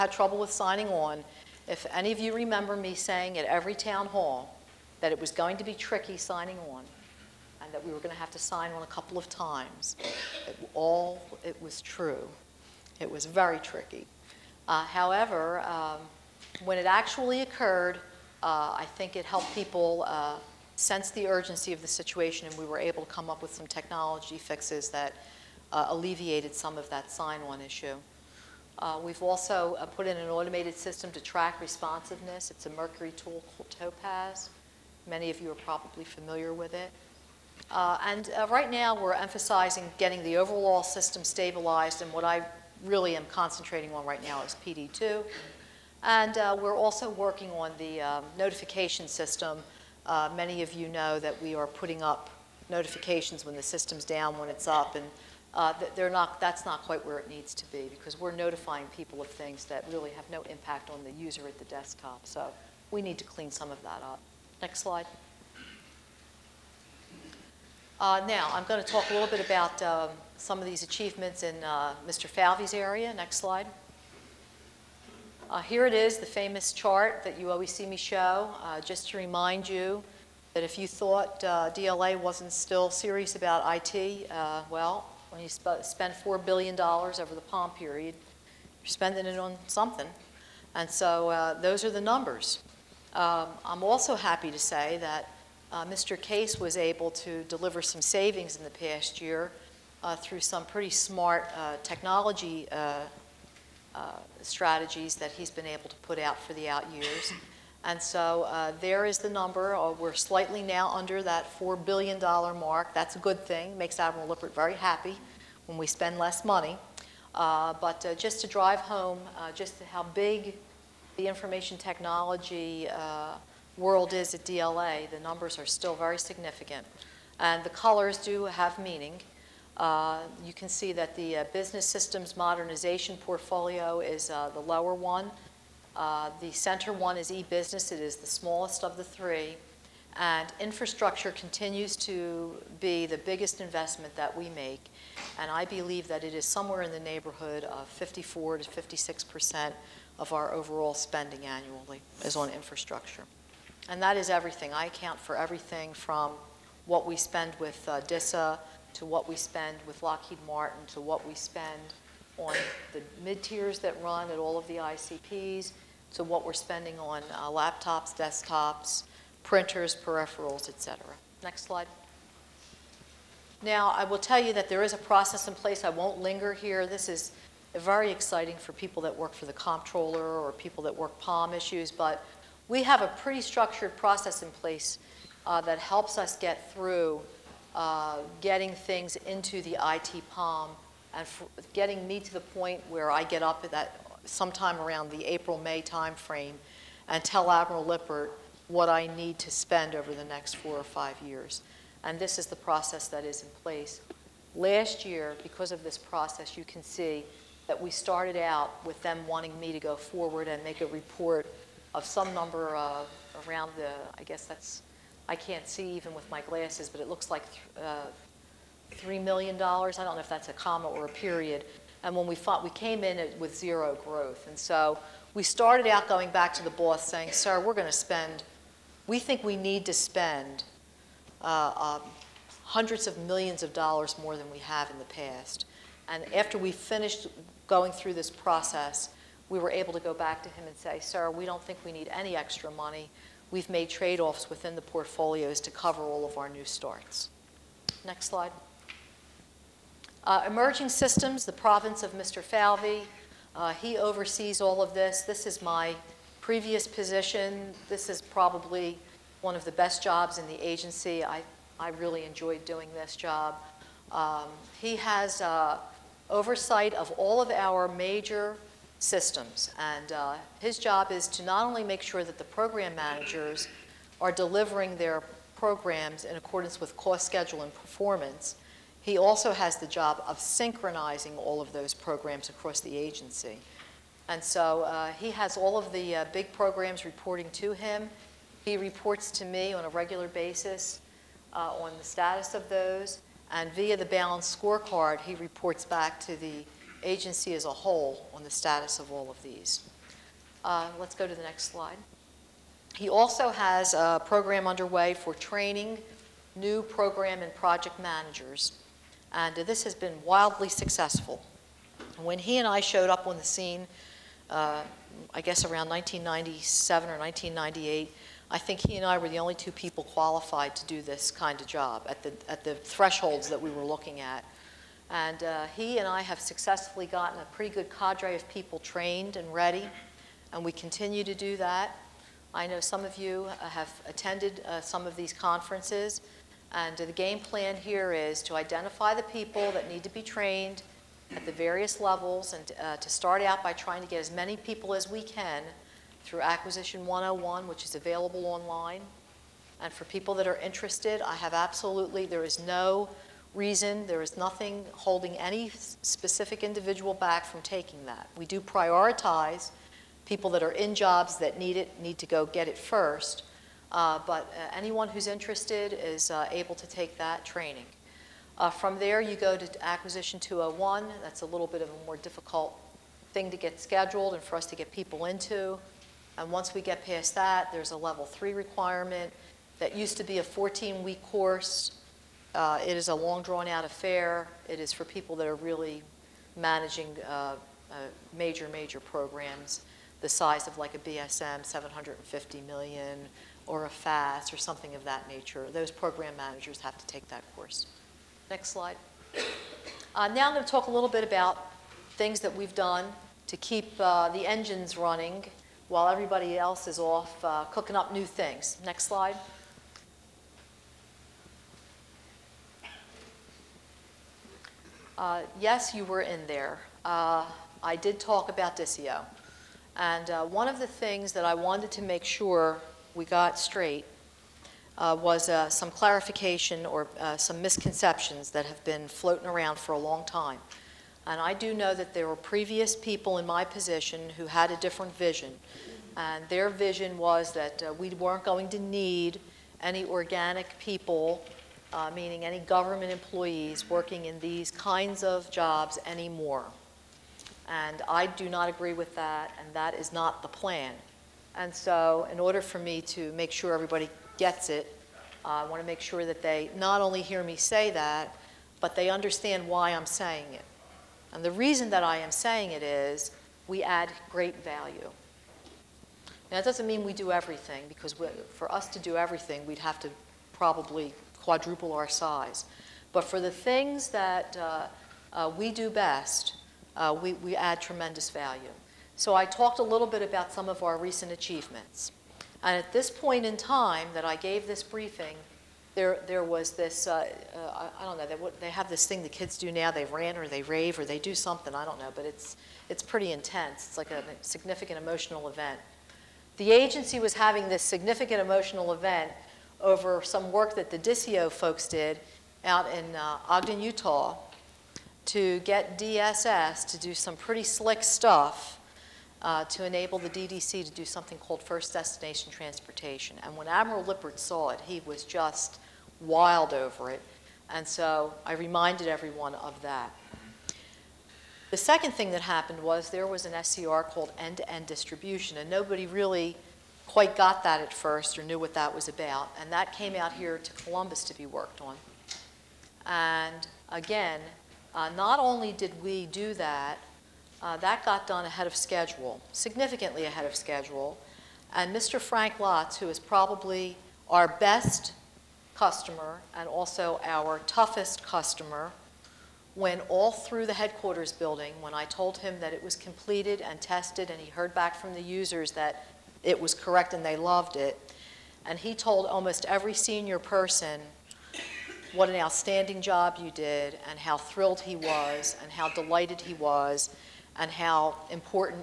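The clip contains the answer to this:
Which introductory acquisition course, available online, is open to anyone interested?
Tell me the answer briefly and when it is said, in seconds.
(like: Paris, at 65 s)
Acquisition 101, at 346 s.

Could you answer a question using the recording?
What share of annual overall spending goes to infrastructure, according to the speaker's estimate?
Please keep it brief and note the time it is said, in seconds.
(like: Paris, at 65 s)
54 to 56 percent, at 147 s.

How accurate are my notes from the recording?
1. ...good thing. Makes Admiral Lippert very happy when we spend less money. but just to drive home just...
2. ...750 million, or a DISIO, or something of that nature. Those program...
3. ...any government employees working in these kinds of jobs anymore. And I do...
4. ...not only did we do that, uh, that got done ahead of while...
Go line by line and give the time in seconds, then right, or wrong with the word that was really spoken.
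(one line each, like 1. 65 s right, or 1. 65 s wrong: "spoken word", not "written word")
1. 113 s right
2. 391 s wrong: "FAS", not "DISIO"
3. 442 s right
4. 535 s wrong: "schedule", not "while".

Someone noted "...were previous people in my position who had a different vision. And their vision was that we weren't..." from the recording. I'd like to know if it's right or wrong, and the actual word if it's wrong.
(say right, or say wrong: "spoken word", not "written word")
right.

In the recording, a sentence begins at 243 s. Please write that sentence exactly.
We've made trade-offs within the portfolios to cover all of our new starts.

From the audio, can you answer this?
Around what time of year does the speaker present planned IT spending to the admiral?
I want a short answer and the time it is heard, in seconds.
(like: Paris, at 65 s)
April May timeframe, at 195 s.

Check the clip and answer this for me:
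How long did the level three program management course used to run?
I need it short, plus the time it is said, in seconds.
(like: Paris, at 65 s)
14 weeks, at 380 s.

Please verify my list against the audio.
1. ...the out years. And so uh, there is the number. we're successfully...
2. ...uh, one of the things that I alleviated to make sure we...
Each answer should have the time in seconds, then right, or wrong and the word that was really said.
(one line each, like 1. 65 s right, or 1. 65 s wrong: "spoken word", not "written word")
1. 106 s wrong: "slightly", not "successfully"
2. 420 s wrong: "wanted", not "alleviated".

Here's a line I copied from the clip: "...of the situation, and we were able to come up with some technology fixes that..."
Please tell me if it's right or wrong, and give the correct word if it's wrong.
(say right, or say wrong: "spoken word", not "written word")
right.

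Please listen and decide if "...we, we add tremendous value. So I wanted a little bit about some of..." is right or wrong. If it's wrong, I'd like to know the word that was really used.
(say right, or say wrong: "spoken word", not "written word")
wrong: "talked", not "wanted".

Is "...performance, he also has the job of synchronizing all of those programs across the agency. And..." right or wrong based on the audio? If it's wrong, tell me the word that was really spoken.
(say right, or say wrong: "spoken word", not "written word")
right.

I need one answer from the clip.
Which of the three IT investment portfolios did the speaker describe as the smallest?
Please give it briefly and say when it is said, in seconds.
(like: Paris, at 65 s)
e-business, at 137 s.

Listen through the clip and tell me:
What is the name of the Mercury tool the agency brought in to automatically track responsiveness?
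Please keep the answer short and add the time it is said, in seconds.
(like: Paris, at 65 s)
Topaz, at 33 s.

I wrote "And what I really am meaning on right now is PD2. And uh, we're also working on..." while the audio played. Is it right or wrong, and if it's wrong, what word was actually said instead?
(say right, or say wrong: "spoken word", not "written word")
wrong: "concentrating", not "meaning".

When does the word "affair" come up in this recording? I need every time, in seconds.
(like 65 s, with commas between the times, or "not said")
383 s.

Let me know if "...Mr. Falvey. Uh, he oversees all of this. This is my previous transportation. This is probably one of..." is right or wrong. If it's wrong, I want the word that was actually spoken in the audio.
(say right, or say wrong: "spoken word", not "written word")
wrong: "position", not "transportation".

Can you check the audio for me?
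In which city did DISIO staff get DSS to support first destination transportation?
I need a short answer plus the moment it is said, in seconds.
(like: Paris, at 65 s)
Ogden, Utah, at 503 s.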